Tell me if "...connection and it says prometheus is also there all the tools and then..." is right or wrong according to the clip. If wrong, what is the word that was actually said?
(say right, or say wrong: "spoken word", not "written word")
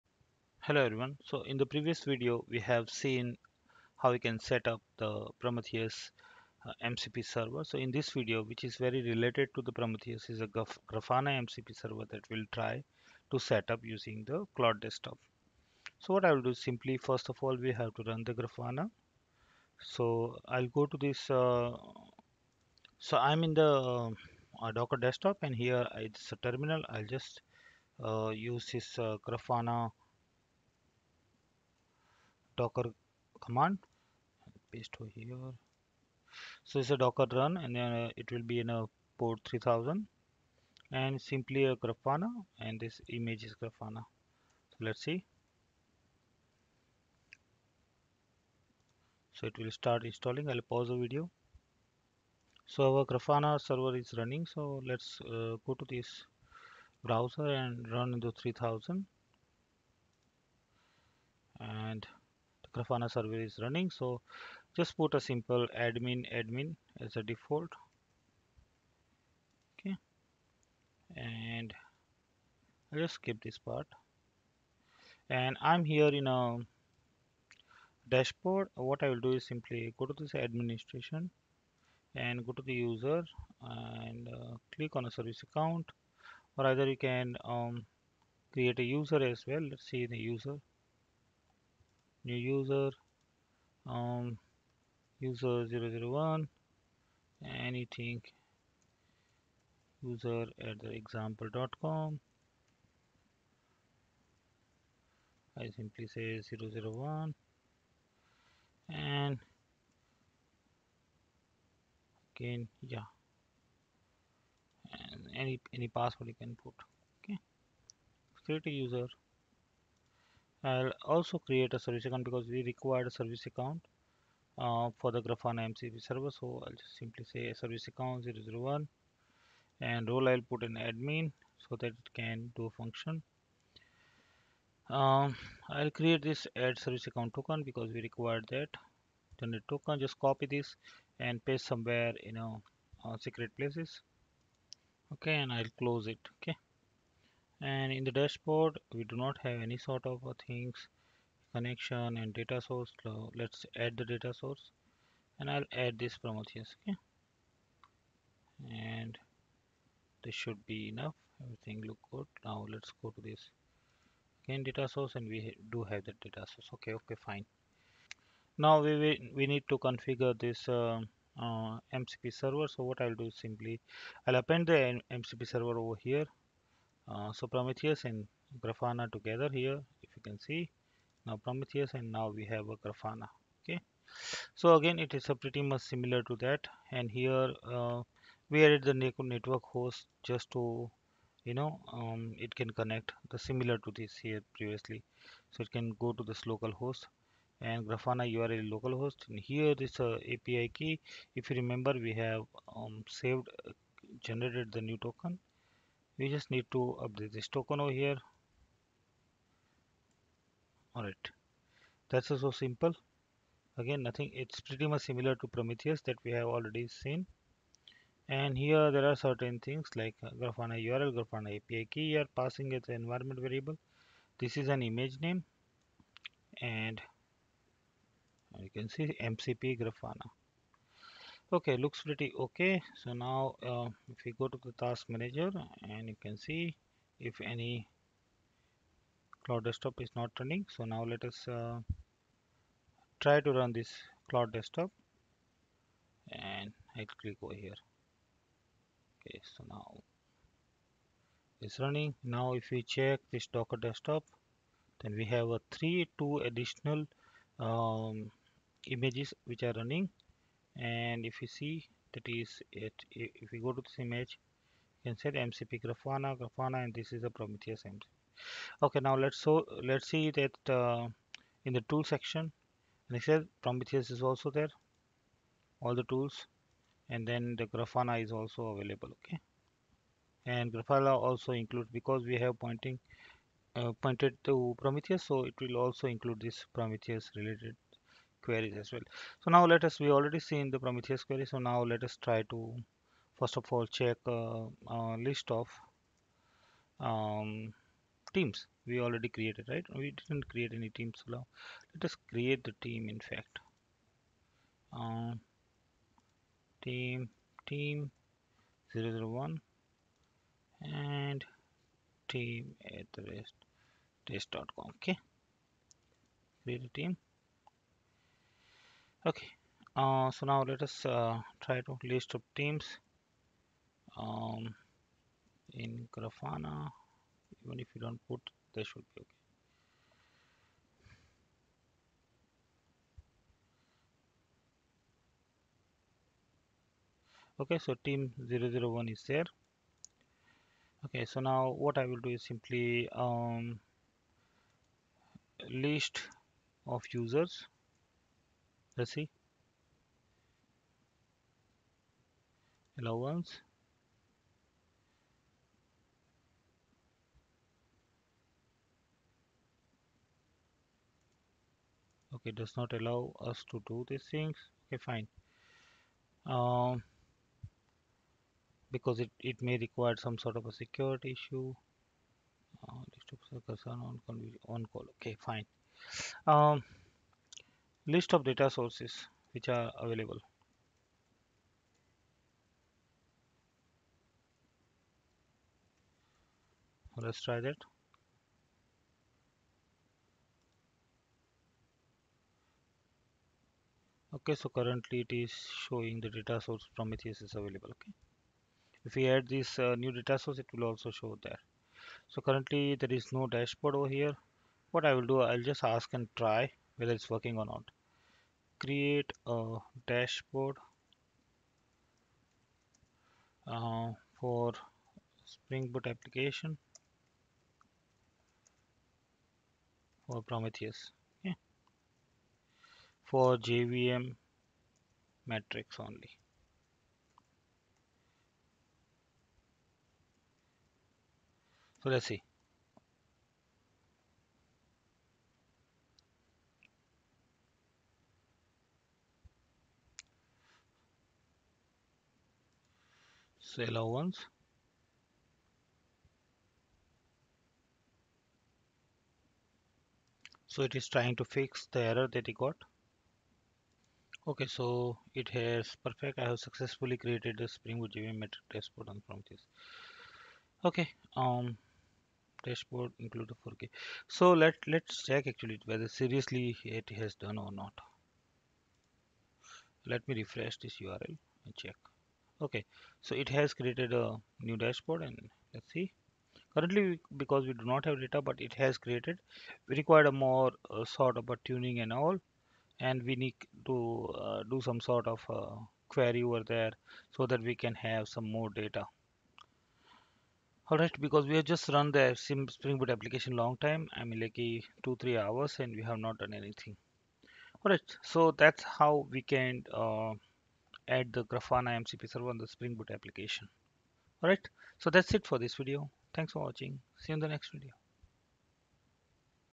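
wrong: "section", not "connection".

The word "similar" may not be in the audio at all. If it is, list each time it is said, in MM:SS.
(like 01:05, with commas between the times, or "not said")
03:05, 03:13, 03:35.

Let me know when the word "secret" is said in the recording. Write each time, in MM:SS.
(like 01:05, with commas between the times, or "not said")
02:23.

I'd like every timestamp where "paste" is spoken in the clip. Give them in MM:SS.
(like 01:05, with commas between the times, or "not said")
00:34, 02:21.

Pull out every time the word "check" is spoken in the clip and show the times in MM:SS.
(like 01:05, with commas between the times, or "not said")
04:12, 04:53, 07:45, 07:51.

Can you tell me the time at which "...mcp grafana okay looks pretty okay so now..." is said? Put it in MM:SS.
03:49.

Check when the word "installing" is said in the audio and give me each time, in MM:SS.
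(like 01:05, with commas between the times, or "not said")
00:50.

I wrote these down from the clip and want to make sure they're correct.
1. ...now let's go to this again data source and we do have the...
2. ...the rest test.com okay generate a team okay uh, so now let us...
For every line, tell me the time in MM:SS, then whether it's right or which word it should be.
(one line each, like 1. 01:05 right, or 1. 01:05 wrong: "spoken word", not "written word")
1. 02:42 right
2. 05:13 wrong: "create", not "generate".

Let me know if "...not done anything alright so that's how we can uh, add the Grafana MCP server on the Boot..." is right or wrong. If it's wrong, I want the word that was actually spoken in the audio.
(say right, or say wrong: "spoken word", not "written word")
wrong: "Spring", not "Boot".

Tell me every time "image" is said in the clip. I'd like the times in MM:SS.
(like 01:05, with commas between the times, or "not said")
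00:43, 03:44, 04:18, 04:23.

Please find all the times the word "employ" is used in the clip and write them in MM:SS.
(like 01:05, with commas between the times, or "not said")
not said.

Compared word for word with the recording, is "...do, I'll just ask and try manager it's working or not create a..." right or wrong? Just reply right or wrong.
wrong.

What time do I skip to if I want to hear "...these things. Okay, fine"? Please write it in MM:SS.
06:04.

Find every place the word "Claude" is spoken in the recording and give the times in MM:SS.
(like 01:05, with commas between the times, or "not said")
00:14, 03:59, 04:04.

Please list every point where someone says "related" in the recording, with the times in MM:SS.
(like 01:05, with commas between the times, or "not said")
00:09, 04:47.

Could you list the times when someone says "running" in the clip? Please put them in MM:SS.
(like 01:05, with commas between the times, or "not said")
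00:54, 01:03, 04:00, 04:11, 04:19.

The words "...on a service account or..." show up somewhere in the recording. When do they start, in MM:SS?
01:24.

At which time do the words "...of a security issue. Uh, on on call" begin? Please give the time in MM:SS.
06:10.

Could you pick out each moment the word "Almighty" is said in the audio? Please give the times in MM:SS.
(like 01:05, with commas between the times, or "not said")
not said.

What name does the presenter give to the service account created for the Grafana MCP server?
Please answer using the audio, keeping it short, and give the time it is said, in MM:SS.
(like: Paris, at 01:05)
service account 001, at 02:07.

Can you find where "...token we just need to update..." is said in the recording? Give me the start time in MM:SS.
03:25.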